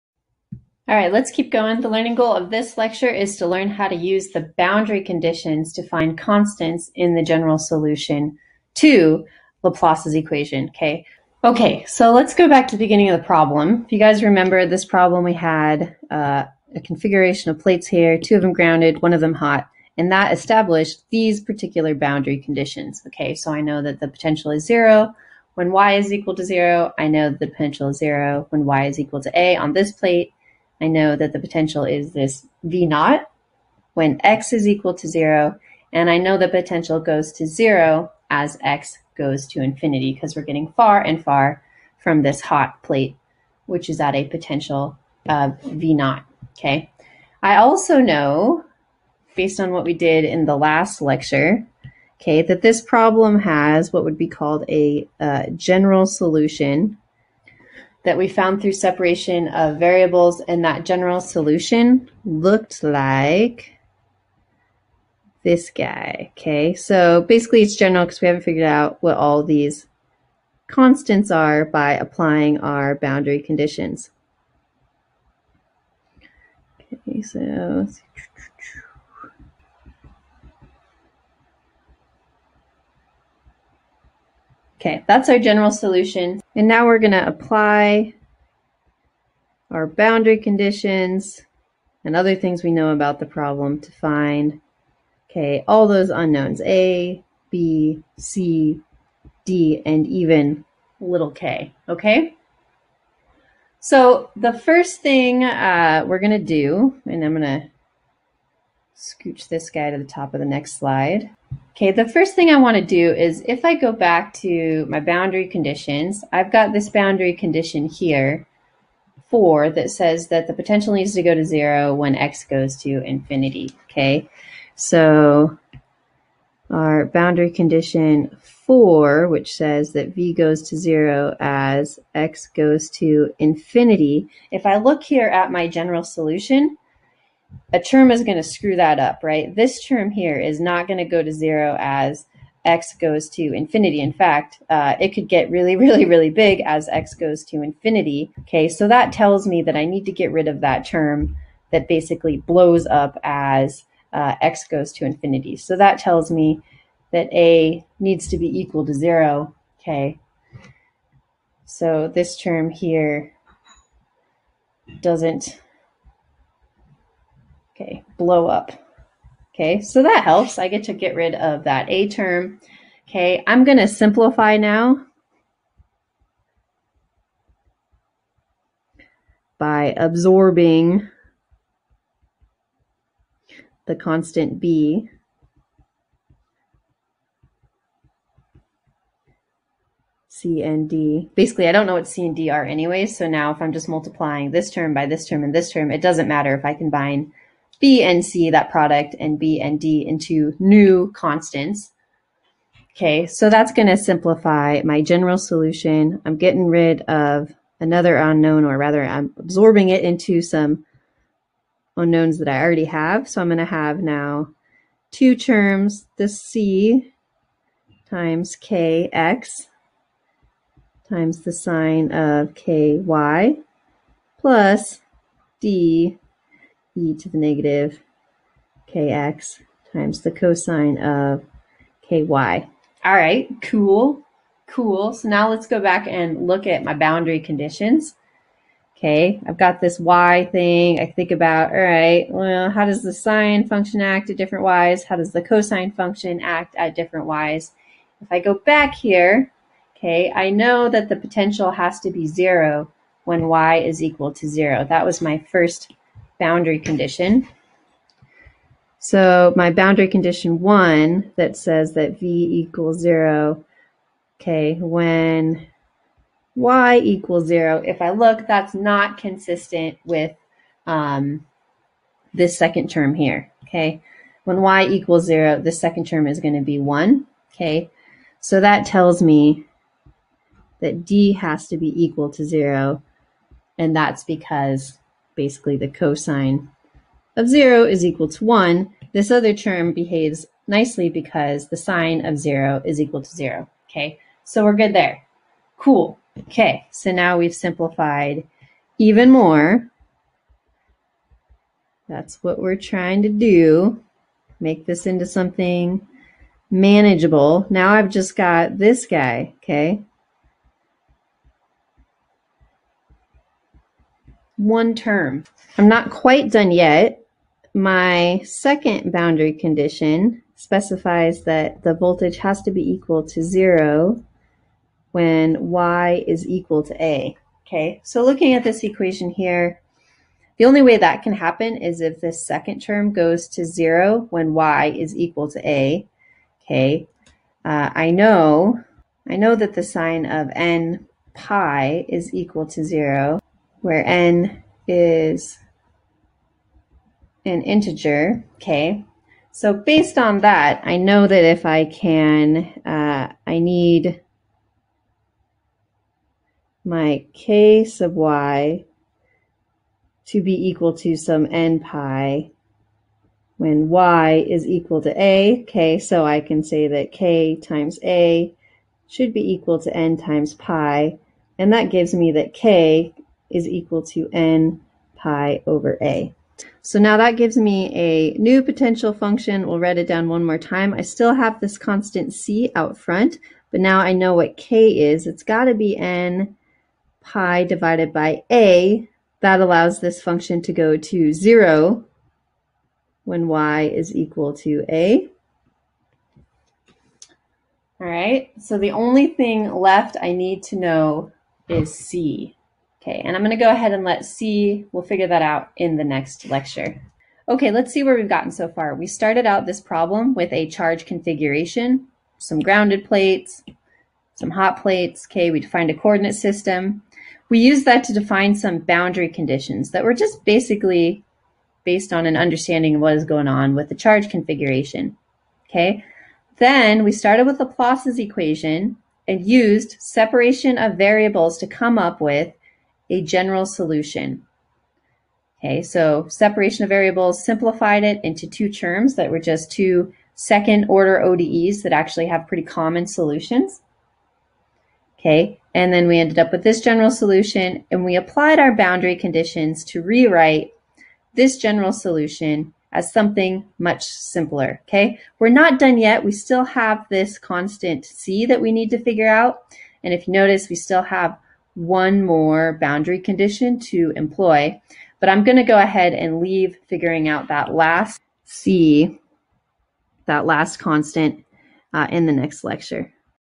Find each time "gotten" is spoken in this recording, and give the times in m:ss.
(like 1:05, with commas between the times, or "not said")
6:48.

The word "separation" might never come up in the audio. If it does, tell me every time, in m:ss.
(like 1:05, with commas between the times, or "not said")
0:58, 7:09, 7:16.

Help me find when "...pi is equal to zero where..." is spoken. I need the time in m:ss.
5:41.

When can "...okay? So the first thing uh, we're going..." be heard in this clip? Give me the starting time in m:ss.
1:41.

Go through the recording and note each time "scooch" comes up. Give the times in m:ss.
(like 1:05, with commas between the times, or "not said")
1:48.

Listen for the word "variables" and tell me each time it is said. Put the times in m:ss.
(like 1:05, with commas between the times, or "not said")
0:59, 7:10, 7:16.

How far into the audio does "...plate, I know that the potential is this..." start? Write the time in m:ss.
0:29.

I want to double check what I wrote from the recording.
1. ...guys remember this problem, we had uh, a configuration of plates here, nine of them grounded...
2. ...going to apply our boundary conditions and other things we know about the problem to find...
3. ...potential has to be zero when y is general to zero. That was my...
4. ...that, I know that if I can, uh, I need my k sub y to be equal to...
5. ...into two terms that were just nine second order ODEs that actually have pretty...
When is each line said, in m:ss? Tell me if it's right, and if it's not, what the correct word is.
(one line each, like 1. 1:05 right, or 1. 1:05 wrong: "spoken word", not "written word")
1. 0:13 wrong: "two", not "nine"
2. 1:26 right
3. 4:11 wrong: "equal", not "general"
4. 5:50 right
5. 7:18 wrong: "two", not "nine".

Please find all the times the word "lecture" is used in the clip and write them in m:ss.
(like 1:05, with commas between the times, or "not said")
0:02, 0:51, 6:46, 7:52.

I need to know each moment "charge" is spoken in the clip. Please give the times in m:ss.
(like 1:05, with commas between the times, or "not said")
6:50, 7:03.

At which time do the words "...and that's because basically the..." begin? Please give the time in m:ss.
4:43.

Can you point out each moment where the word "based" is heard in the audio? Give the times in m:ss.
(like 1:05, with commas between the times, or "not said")
0:49, 5:49, 7:01.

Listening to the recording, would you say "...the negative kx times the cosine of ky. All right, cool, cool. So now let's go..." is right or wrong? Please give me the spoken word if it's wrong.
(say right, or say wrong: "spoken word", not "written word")
right.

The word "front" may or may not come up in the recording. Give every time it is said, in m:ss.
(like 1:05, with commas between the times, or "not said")
6:22.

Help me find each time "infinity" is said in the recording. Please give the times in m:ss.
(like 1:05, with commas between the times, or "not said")
0:39, 2:03, 2:13, 2:23, 2:27, 2:35.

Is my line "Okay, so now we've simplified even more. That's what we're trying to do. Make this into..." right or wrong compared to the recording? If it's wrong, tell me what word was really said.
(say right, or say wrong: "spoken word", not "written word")
right.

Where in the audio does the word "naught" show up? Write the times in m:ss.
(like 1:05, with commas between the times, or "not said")
0:32, 0:45.